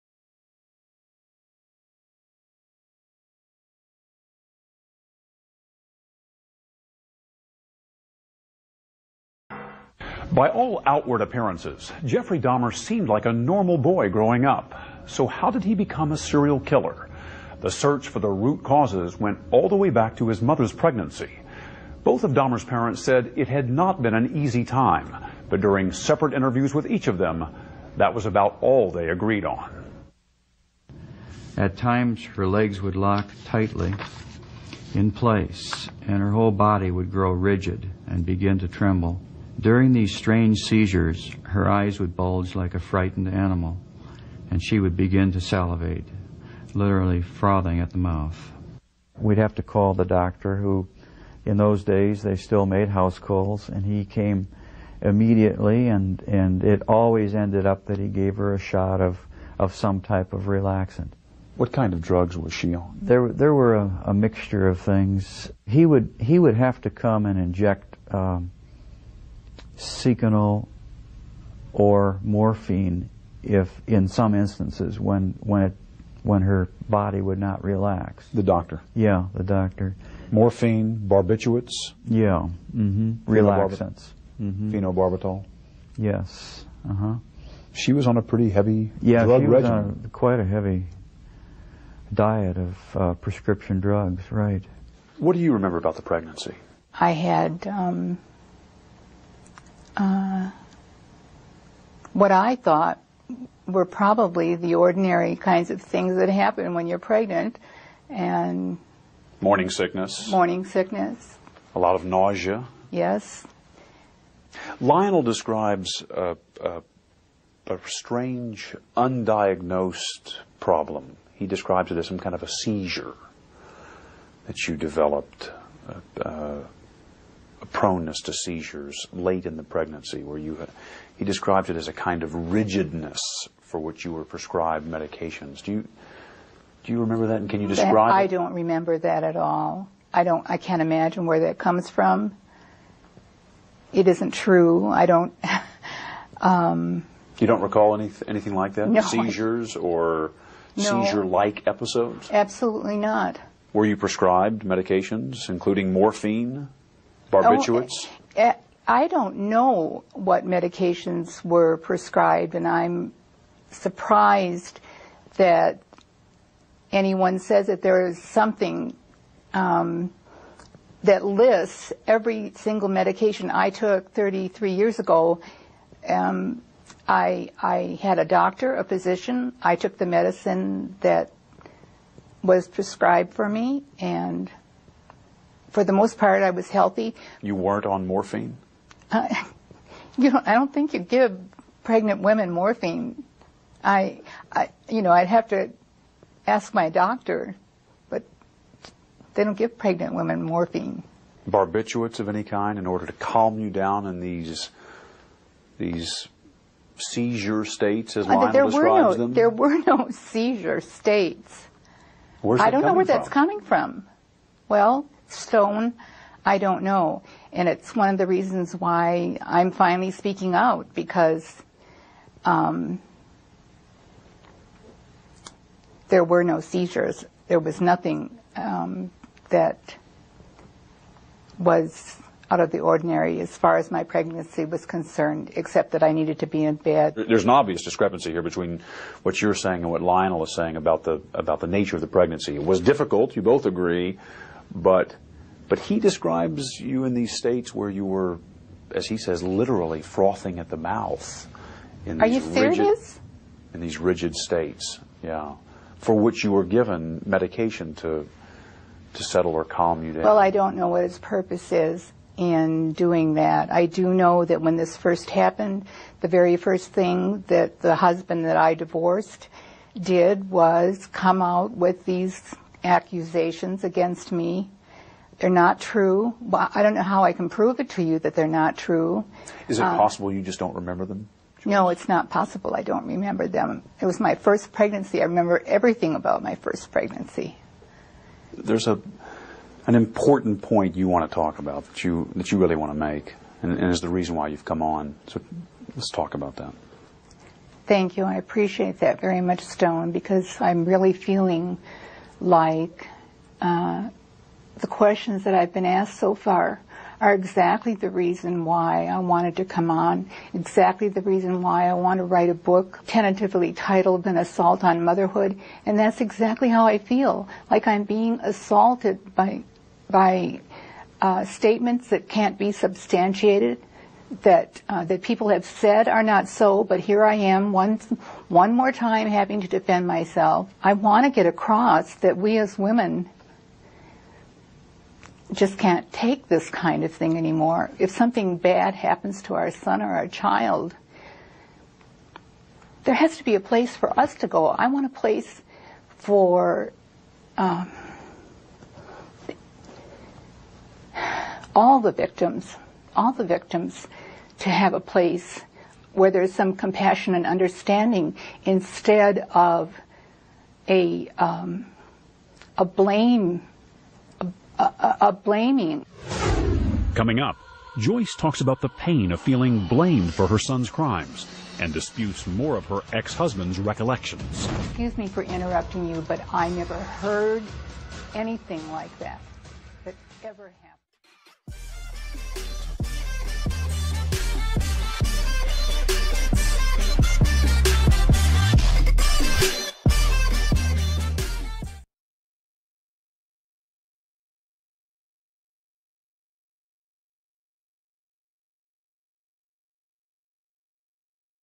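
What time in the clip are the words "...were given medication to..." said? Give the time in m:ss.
4:16.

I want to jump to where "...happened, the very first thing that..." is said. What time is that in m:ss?
4:25.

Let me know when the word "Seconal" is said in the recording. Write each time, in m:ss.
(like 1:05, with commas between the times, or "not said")
1:09.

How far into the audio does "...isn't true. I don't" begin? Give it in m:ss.
2:24.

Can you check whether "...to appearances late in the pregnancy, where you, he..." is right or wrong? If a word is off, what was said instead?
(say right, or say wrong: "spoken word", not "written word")
wrong: "seizures", not "appearances".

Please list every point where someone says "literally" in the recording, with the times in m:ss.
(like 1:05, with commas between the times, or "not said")
0:46, 4:09.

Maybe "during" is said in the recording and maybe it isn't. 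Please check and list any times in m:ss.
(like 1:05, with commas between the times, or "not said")
0:25, 0:39.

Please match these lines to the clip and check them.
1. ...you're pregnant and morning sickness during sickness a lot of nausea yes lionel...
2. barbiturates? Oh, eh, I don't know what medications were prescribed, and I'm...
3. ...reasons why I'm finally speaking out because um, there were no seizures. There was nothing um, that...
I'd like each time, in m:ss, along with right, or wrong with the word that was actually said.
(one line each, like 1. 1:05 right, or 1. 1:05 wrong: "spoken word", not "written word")
1. 1:46 wrong: "morning", not "during"
2. 2:37 right
3. 3:38 right.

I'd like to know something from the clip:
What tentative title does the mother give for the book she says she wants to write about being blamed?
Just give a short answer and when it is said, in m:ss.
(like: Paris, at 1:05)
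An Assault on Motherhood, at 5:14.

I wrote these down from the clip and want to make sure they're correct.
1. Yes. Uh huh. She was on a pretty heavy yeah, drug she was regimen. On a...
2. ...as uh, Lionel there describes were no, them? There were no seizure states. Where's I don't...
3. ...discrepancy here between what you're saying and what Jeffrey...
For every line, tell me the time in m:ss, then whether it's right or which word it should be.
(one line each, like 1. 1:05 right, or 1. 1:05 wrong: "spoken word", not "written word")
1. 1:25 right
2. 3:28 right
3. 3:57 wrong: "Lionel", not "Jeffrey".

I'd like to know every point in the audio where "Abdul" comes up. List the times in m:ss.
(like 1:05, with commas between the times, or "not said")
not said.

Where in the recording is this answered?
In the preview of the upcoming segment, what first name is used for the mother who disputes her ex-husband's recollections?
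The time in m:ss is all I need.
6:07.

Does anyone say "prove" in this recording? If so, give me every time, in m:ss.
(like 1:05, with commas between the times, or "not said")
4:37.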